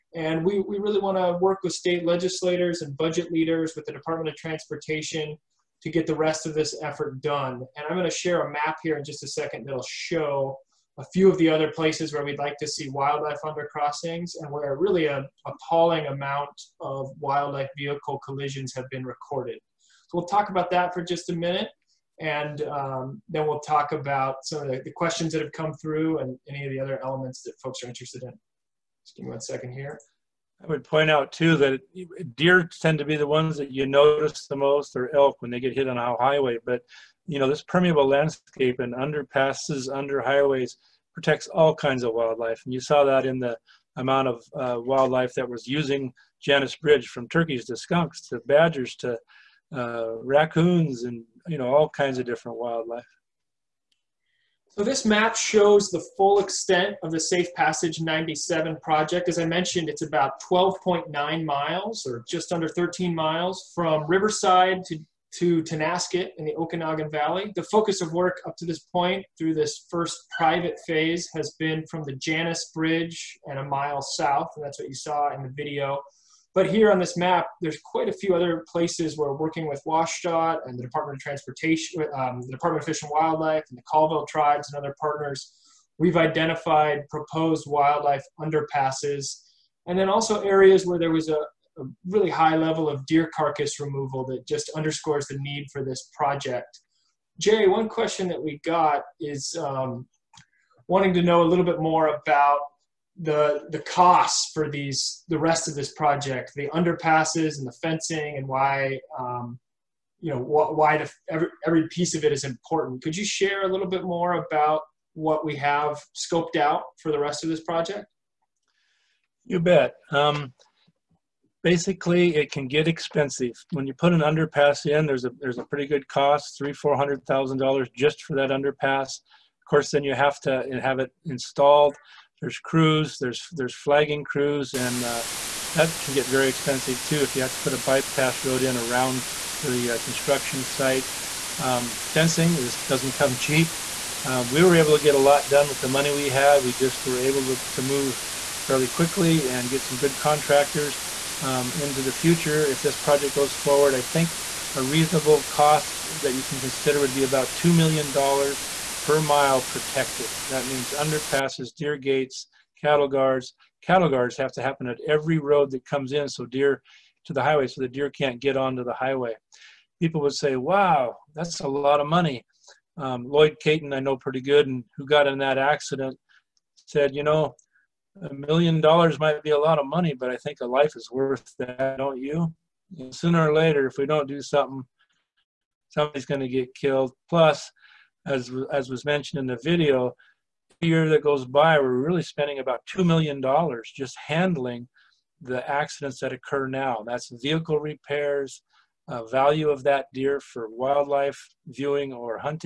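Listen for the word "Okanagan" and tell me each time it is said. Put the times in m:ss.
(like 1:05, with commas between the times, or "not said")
1:06.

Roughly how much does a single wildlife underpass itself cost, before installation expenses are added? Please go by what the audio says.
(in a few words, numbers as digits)
$300,000-$400,000.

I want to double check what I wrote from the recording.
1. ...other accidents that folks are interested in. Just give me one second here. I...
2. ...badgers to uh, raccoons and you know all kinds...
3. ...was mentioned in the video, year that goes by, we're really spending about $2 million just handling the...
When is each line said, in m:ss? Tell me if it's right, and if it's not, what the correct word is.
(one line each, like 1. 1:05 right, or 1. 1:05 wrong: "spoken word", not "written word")
1. 0:26 wrong: "elements", not "accidents"
2. 0:48 right
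3. 3:08 right.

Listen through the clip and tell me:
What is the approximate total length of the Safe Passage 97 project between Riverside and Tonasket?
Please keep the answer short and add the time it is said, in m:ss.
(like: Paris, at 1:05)
12.9 miles, at 1:00.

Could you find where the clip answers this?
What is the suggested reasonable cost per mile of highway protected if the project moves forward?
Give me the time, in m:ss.
2:37.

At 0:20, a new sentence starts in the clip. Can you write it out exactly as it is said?
So we'll talk about that for just a minute.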